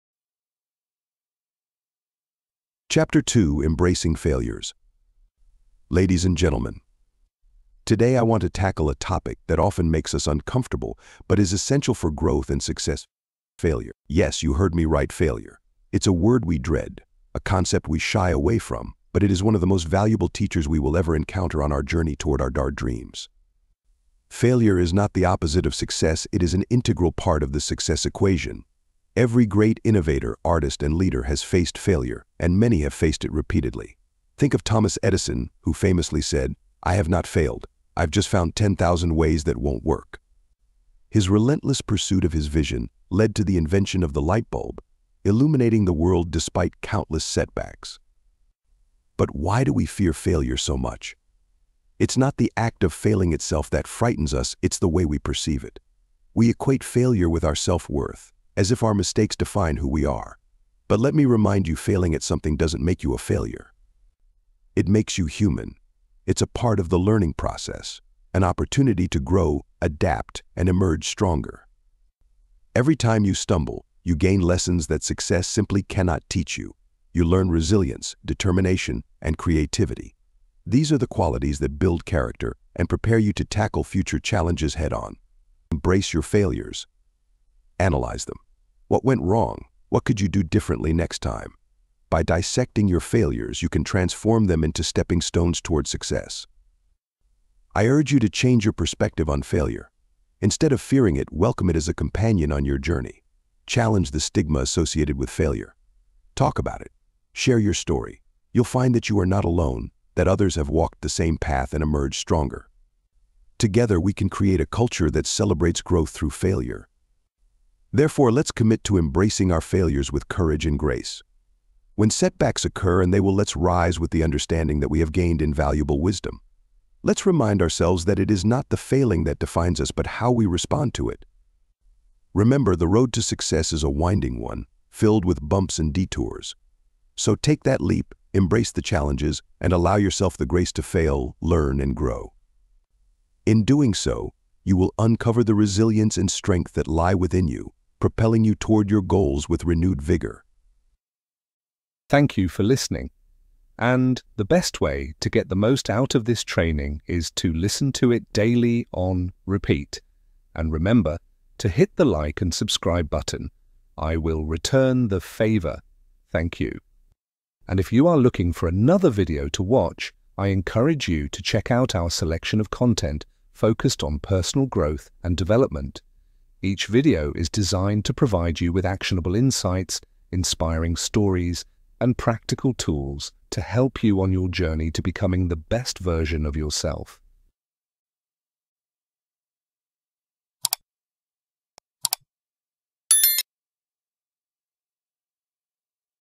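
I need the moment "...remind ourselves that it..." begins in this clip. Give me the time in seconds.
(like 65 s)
127 s.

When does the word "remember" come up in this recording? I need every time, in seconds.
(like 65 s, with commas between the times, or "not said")
132 s, 160 s.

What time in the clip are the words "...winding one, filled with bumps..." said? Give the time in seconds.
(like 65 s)
133 s.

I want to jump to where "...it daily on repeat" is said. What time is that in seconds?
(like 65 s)
158 s.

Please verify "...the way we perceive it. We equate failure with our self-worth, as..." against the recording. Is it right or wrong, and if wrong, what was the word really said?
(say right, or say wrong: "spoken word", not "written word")
right.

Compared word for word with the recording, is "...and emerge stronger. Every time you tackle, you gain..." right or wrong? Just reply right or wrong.
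wrong.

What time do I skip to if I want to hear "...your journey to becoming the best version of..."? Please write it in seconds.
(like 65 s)
184 s.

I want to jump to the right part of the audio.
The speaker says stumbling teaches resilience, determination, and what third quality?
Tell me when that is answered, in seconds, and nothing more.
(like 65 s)
79 s.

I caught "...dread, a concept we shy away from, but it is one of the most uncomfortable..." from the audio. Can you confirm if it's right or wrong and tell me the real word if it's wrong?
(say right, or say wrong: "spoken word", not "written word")
wrong: "valuable", not "uncomfortable".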